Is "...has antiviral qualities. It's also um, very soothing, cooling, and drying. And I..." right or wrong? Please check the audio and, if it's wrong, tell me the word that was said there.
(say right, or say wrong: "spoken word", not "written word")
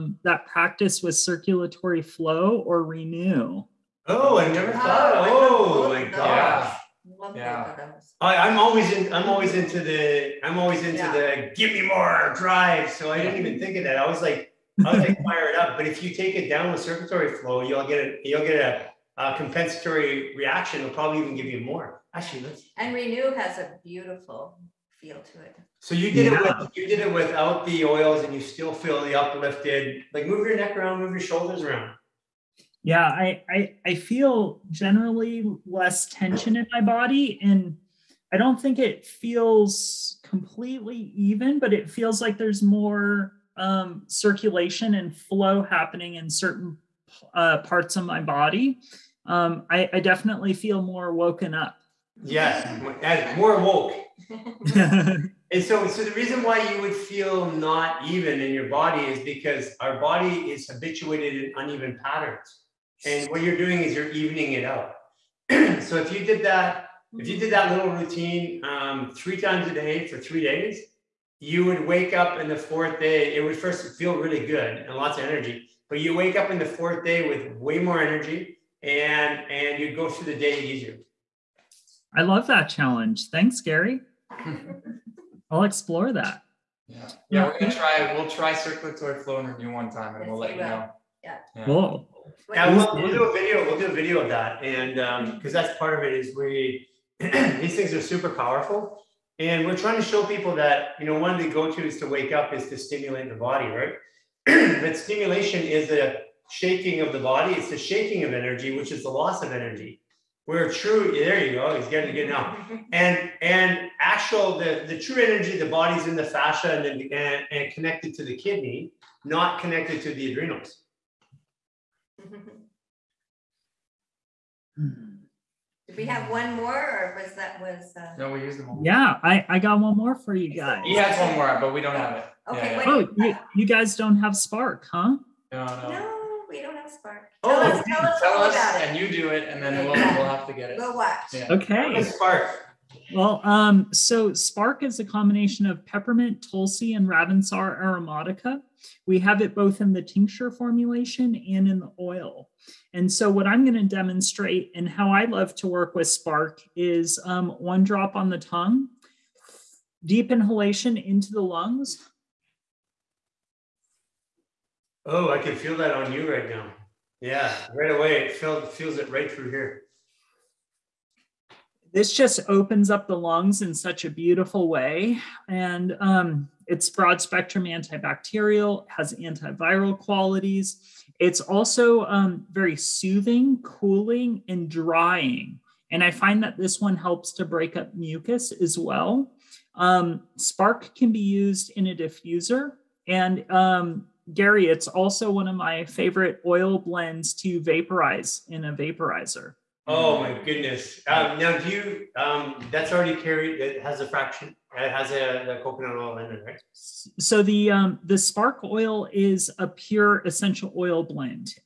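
right.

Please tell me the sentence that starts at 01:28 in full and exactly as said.
We'll try circulatory flow in renew one time, and we'll let you know.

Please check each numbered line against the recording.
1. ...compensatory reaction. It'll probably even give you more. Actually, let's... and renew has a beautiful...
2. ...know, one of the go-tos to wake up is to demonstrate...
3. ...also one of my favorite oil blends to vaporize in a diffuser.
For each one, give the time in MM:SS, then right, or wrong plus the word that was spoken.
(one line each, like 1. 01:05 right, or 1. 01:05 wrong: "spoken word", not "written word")
1. 00:19 right
2. 01:41 wrong: "stimulate", not "demonstrate"
3. 03:14 wrong: "vaporizer", not "diffuser".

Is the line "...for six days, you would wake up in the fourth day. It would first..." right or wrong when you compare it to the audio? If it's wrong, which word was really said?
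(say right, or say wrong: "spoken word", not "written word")
wrong: "three", not "six".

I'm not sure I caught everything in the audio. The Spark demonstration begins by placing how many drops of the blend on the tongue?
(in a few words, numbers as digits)
1.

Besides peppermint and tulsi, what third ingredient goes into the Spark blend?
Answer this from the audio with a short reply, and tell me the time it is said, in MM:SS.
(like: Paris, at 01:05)
Ravensara aromatica, at 02:27.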